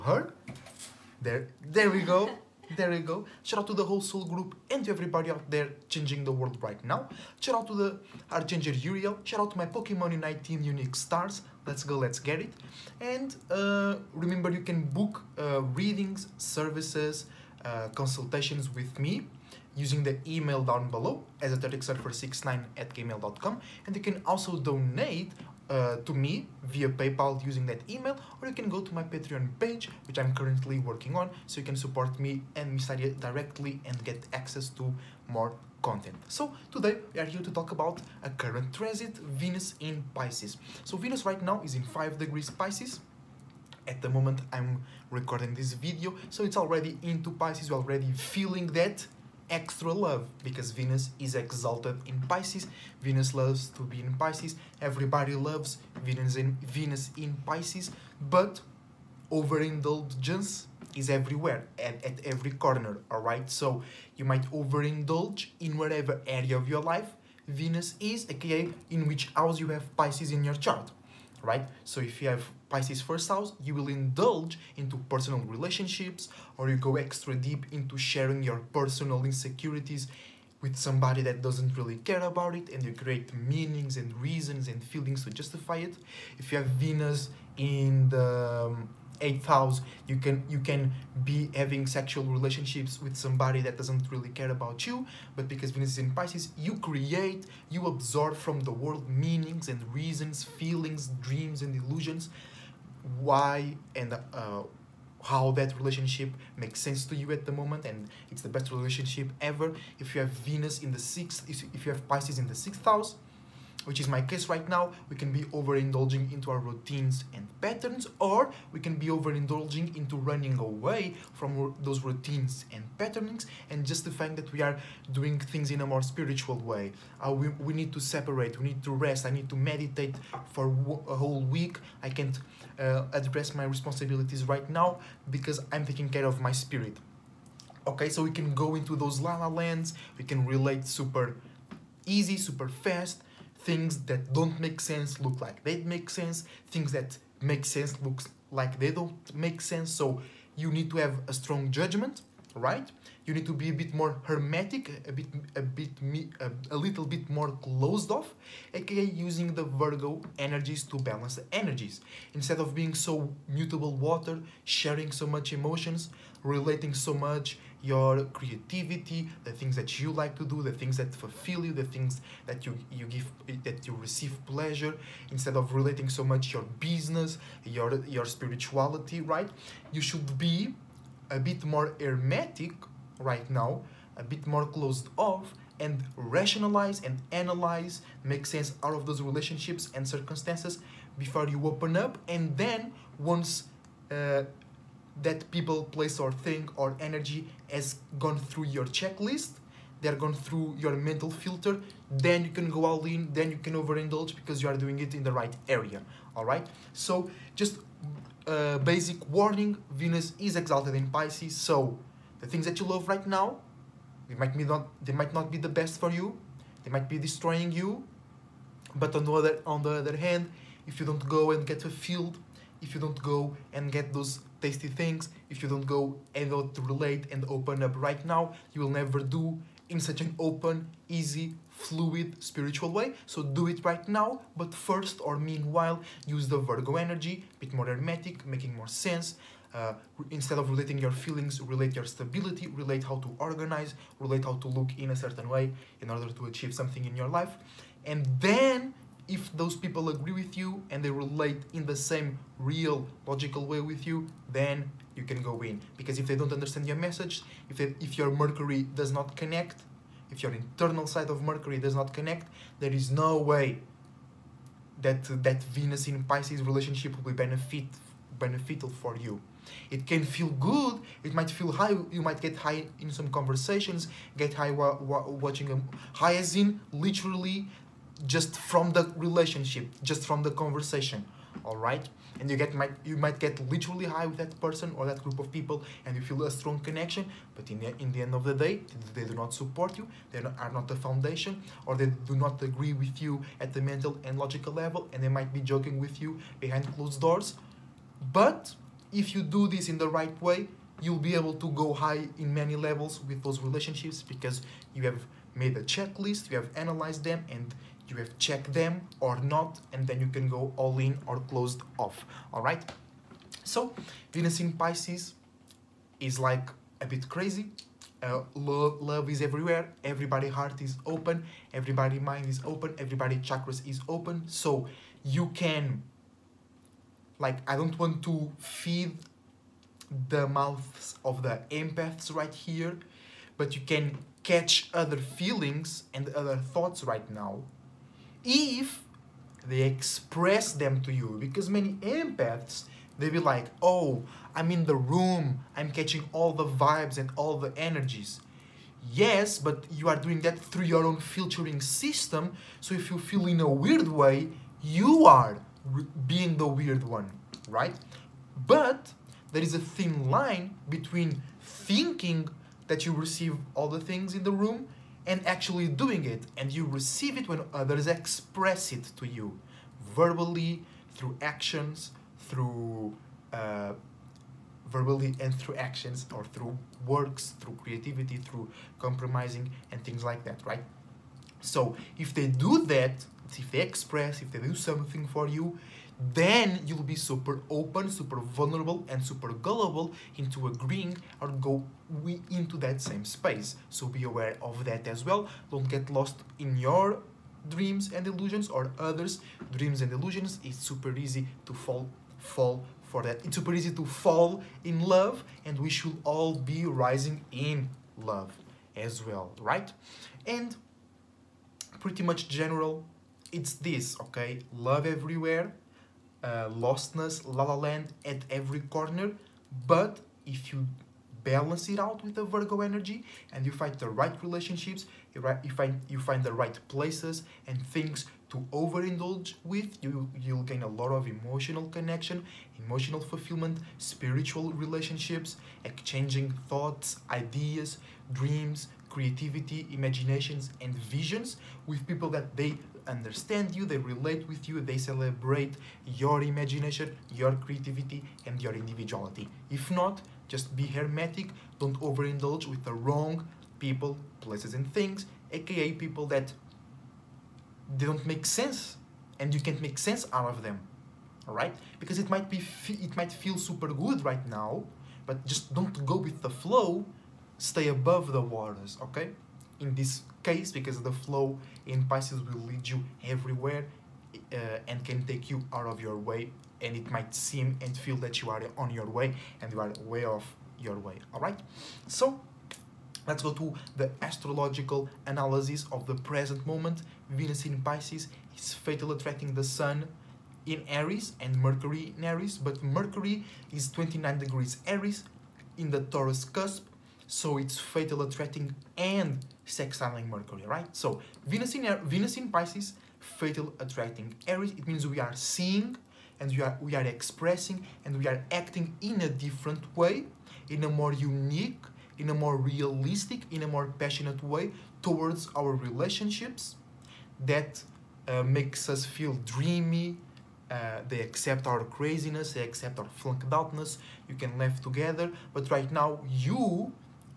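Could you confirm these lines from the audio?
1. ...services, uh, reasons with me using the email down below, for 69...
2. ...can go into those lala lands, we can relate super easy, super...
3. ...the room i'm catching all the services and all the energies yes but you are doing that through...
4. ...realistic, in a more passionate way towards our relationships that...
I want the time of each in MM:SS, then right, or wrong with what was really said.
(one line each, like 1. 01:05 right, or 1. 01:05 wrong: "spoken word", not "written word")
1. 00:16 wrong: "consultations", not "reasons"
2. 02:18 right
3. 05:44 wrong: "vibes", not "services"
4. 08:32 right.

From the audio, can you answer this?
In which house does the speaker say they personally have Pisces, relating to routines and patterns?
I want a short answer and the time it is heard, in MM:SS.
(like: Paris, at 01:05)
Sixth house, at 01:52.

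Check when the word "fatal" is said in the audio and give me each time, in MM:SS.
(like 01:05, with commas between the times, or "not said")
08:08, 08:17, 08:23.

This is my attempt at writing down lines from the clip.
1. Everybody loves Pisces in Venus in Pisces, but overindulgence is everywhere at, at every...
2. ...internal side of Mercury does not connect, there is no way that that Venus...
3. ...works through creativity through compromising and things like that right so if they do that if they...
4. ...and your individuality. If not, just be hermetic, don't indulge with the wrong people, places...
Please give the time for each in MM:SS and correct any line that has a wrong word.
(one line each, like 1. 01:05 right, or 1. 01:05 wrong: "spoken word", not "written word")
1. 00:54 wrong: "Venus", not "Pisces"
2. 04:20 right
3. 06:17 right
4. 07:28 wrong: "overindulge", not "indulge".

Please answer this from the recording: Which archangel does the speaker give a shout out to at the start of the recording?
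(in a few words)
Uriel.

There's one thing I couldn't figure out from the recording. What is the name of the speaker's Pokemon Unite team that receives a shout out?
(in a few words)
Unique Stars.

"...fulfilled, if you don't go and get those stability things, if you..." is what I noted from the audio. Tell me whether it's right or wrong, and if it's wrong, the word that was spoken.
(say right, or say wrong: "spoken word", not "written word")
wrong: "tasty", not "stability".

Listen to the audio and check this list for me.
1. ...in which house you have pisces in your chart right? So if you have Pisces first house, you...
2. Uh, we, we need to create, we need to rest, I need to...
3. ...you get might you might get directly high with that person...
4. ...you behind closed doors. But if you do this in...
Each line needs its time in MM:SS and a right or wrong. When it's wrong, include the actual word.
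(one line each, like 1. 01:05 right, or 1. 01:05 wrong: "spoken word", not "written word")
1. 01:08 right
2. 02:07 wrong: "separate", not "create"
3. 04:42 wrong: "literally", not "directly"
4. 04:56 right.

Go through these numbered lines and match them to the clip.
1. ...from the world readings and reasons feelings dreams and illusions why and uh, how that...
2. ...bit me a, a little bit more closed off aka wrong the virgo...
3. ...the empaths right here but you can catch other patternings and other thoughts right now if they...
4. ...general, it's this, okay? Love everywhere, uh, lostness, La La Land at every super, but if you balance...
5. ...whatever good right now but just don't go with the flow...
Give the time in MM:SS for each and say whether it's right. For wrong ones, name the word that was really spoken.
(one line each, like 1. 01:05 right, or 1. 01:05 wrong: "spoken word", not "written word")
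1. 01:38 wrong: "meanings", not "readings"
2. 02:35 wrong: "using", not "wrong"
3. 05:31 wrong: "feelings", not "patternings"
4. 06:52 wrong: "corner", not "super"
5. 07:43 wrong: "super", not "whatever".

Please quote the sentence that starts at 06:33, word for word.
So be aware of that as well.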